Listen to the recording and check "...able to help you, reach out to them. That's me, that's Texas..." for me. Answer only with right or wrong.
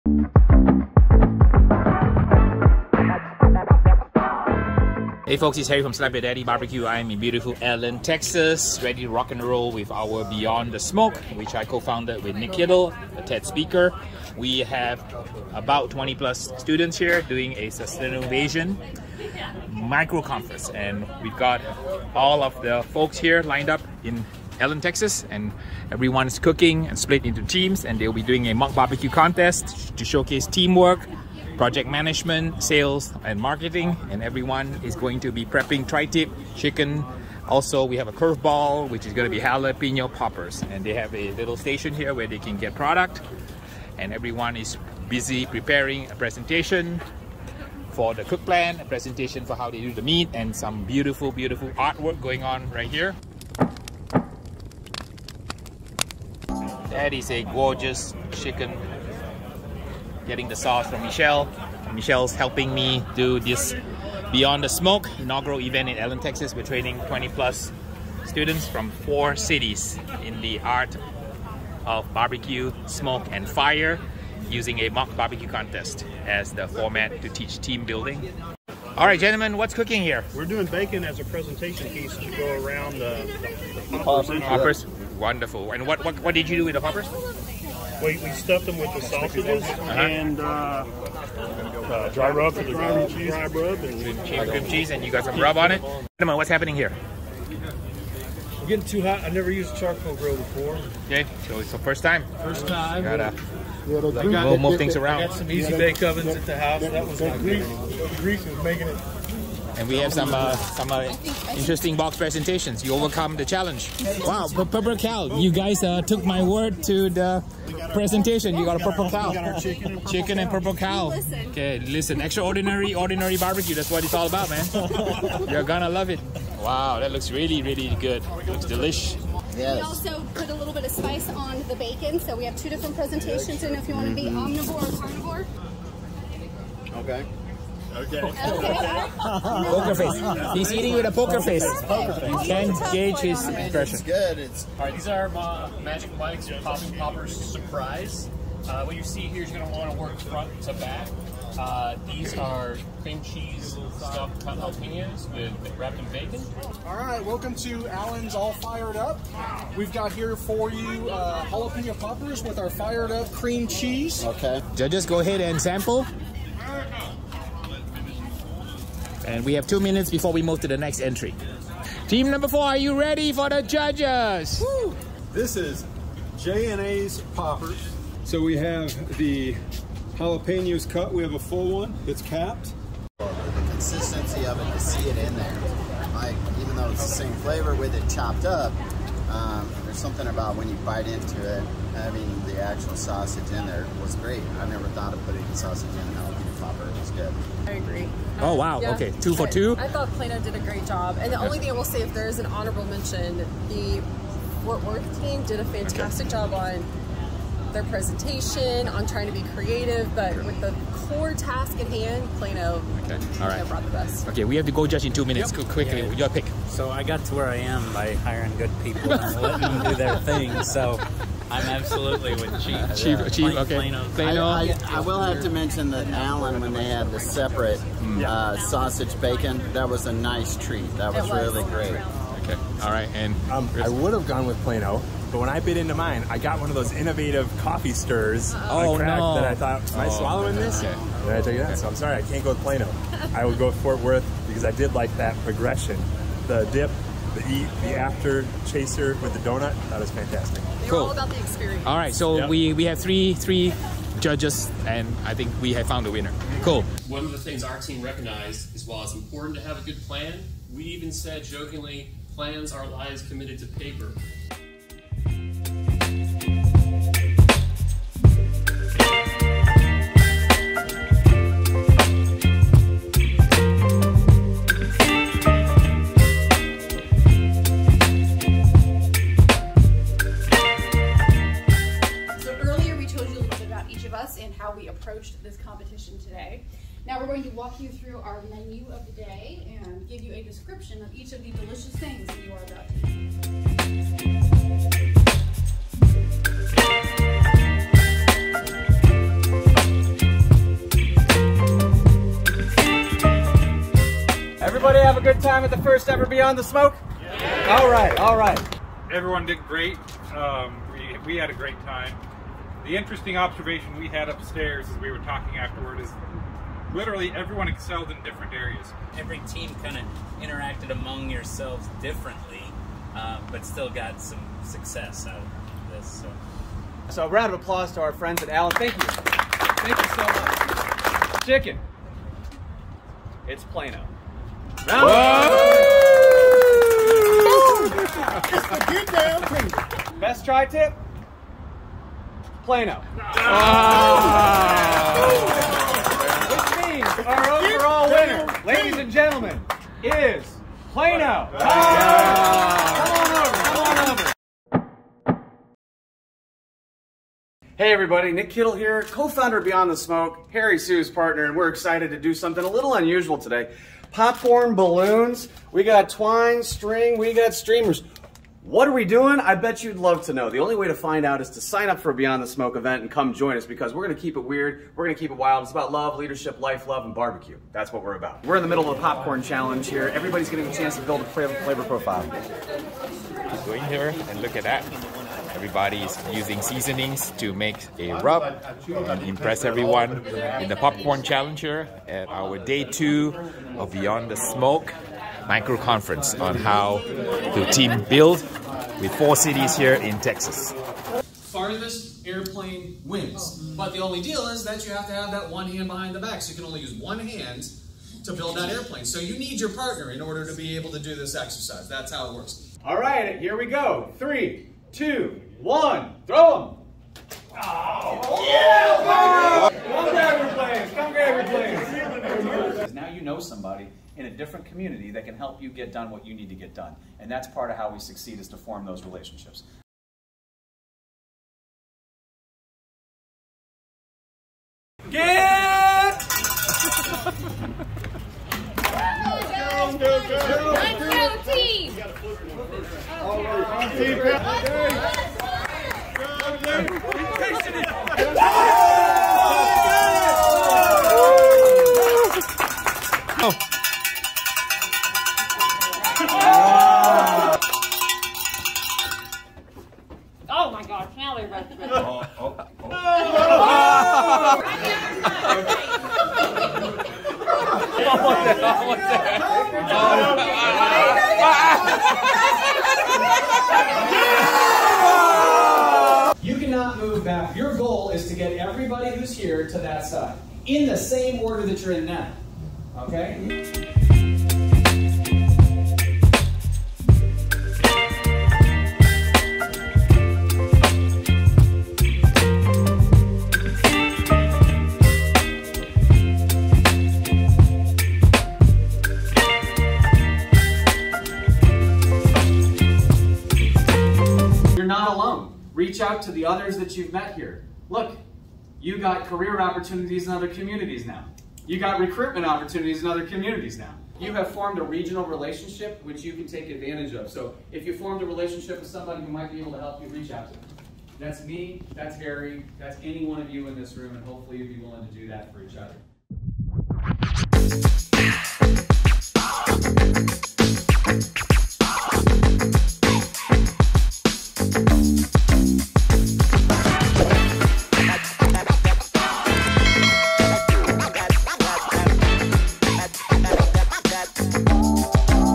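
wrong.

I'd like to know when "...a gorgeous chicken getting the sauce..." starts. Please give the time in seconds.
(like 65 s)
57 s.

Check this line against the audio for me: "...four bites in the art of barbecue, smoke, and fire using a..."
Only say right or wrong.
wrong.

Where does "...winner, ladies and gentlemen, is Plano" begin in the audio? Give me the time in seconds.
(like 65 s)
348 s.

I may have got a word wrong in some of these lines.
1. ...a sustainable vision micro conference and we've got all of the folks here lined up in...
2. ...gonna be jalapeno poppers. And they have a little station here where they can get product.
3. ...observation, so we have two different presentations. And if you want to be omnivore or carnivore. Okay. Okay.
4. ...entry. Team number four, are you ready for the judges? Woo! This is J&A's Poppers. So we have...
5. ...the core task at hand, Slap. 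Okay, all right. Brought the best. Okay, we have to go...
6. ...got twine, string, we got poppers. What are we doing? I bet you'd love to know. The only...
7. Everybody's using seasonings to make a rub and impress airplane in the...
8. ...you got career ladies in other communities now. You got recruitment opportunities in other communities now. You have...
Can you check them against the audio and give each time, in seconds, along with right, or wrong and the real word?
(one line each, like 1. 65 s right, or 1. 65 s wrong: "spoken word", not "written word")
1. 17 s right
2. 39 s right
3. 131 s wrong: "bacon", not "observation"
4. 170 s right
5. 210 s wrong: "Plano", not "Slap"
6. 365 s wrong: "streamers", not "poppers"
7. 385 s wrong: "everyone", not "airplane"
8. 508 s wrong: "opportunities", not "ladies".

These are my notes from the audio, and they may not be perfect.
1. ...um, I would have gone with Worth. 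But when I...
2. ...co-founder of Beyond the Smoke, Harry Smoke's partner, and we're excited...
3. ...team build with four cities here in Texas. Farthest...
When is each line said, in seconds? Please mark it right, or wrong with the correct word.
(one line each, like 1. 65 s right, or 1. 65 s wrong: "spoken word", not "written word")
1. 233 s wrong: "Plano", not "Worth"
2. 359 s wrong: "Soo", not "Smoke"
3. 397 s right.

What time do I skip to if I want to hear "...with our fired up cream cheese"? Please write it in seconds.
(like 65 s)
162 s.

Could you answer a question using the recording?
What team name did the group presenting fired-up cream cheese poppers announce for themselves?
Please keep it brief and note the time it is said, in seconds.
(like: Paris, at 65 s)
Allen's All Fired Up, at 157 s.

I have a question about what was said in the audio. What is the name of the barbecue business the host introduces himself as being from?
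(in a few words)
Slap Yo Daddy Barbecue.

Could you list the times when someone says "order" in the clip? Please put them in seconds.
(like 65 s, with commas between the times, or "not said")
410 s, 481 s.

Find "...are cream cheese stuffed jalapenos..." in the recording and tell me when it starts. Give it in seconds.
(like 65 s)
152 s.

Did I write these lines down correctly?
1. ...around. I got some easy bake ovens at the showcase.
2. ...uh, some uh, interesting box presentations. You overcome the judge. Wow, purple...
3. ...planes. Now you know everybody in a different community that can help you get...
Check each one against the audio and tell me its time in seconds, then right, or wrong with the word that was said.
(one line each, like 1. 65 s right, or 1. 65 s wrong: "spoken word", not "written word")
1. 104 s wrong: "house", not "showcase"
2. 110 s wrong: "challenge", not "judge"
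3. 422 s wrong: "somebody", not "everybody".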